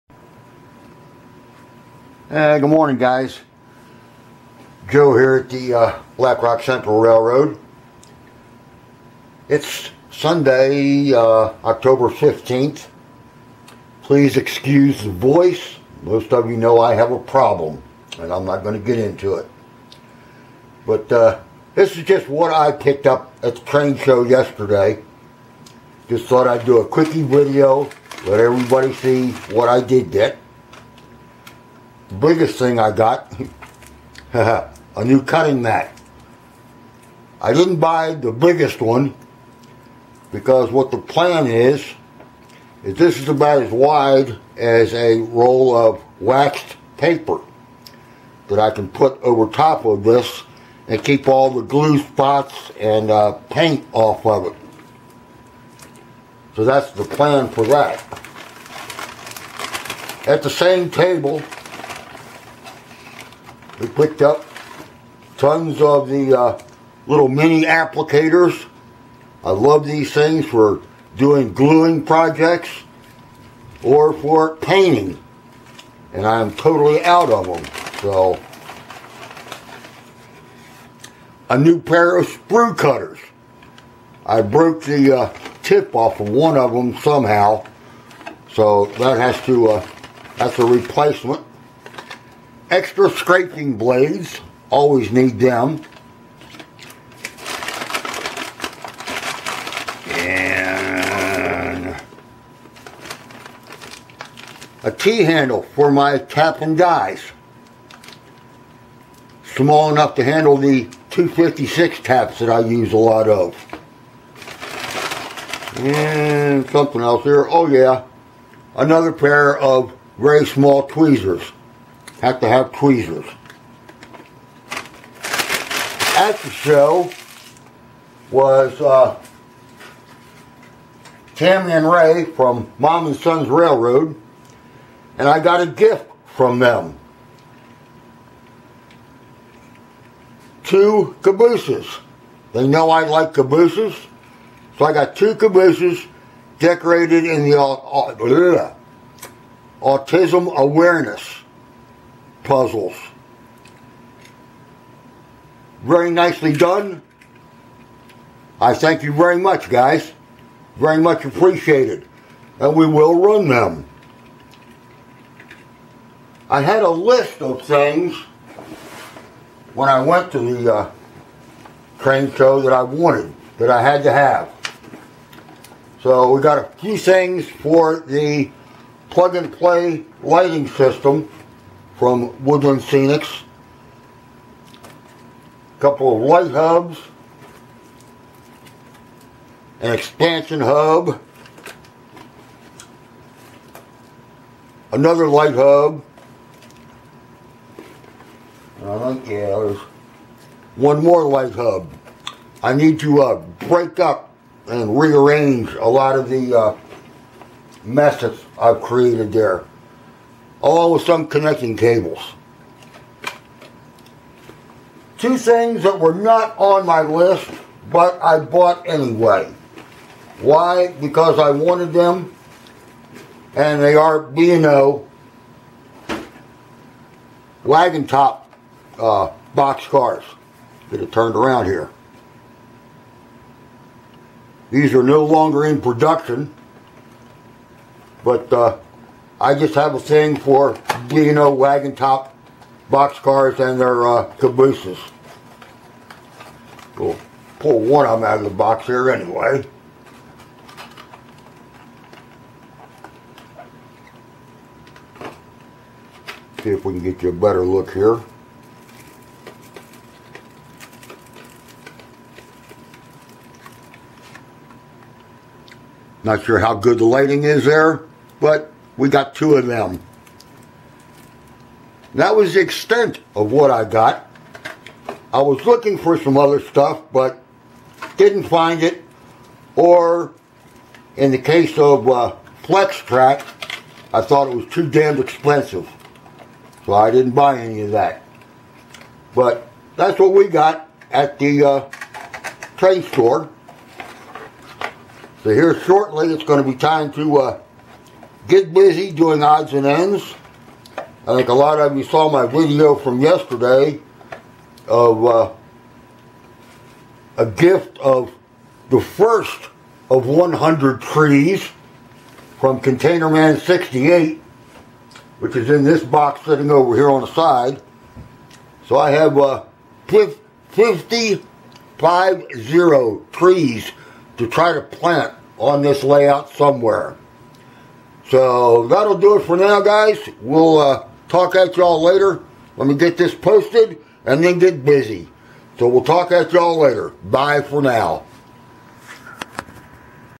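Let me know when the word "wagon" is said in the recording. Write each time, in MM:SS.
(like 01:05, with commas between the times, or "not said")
03:47, 04:01.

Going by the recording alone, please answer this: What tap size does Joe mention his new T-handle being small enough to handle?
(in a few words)
256.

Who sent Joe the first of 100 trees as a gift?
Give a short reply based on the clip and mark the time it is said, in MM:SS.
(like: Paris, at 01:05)
Container Man 68, at 05:12.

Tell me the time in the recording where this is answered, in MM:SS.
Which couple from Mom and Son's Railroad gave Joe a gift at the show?
02:11.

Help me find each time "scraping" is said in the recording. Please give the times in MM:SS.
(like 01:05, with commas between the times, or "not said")
01:33.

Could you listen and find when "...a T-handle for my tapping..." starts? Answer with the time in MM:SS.
01:44.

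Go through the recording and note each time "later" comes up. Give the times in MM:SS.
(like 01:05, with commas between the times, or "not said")
05:32, 05:36.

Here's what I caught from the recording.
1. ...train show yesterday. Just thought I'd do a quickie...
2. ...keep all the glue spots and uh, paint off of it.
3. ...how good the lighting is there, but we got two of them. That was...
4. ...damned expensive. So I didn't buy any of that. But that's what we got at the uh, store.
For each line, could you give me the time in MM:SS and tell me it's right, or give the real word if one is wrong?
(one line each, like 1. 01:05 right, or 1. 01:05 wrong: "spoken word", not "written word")
1. 00:23 right
2. 00:51 right
3. 04:26 right
4. 04:44 right.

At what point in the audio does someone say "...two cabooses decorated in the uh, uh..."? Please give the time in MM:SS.
02:25.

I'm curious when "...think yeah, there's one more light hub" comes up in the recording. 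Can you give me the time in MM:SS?
03:19.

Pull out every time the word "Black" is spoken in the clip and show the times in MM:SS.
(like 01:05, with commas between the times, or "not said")
00:06.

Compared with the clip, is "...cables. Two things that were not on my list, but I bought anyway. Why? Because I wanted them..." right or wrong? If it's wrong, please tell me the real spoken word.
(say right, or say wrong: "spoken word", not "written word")
right.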